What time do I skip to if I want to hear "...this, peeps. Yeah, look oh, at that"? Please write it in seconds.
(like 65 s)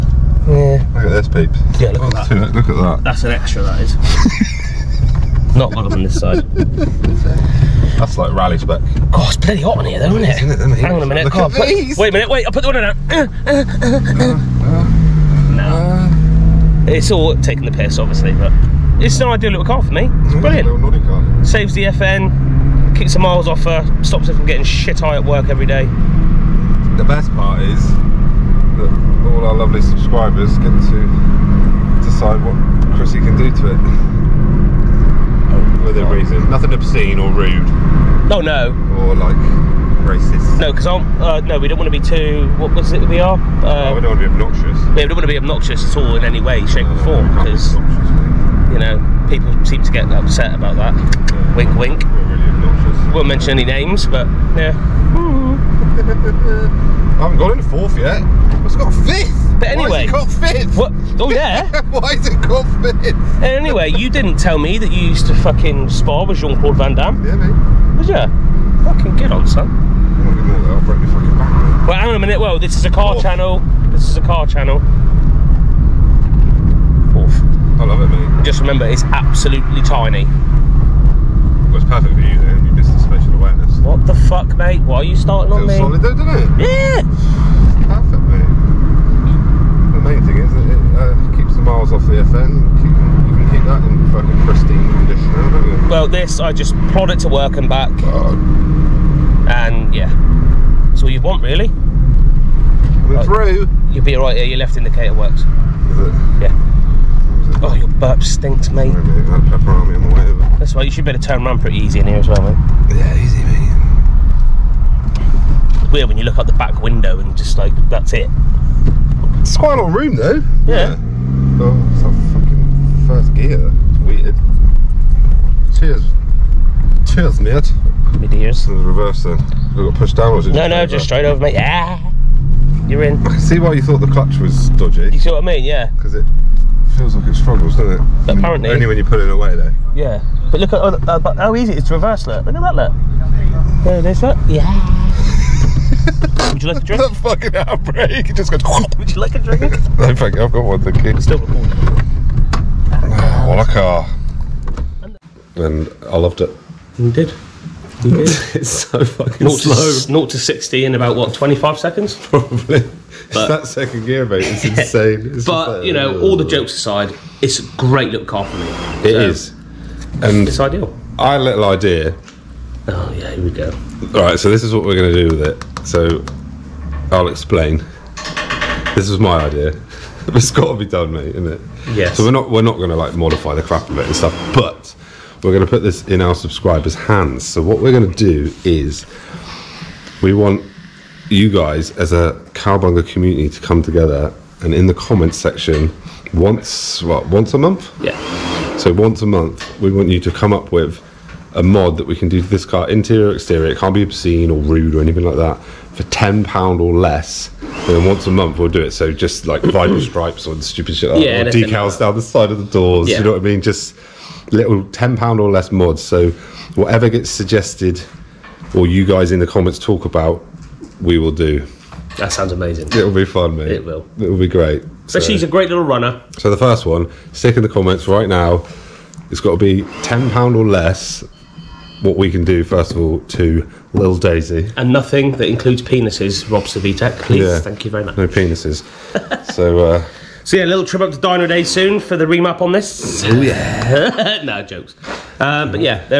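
1 s.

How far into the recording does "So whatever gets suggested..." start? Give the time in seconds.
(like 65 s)
216 s.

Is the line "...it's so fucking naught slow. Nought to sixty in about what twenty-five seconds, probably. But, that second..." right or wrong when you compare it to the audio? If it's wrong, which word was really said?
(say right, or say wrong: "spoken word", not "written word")
right.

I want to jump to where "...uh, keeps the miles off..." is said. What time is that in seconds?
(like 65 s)
90 s.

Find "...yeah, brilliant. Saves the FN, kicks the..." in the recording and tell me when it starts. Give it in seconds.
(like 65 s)
20 s.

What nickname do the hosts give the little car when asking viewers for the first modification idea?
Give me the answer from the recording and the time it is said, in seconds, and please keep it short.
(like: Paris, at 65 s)
Lil Daisy, at 233 s.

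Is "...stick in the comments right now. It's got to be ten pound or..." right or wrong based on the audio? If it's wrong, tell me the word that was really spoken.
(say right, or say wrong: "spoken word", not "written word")
right.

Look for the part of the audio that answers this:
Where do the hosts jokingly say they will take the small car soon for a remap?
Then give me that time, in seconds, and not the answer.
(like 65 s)
241 s.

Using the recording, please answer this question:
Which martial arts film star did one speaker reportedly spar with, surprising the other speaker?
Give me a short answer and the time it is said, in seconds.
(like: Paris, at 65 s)
Jean Claude Van Damme, at 66 s.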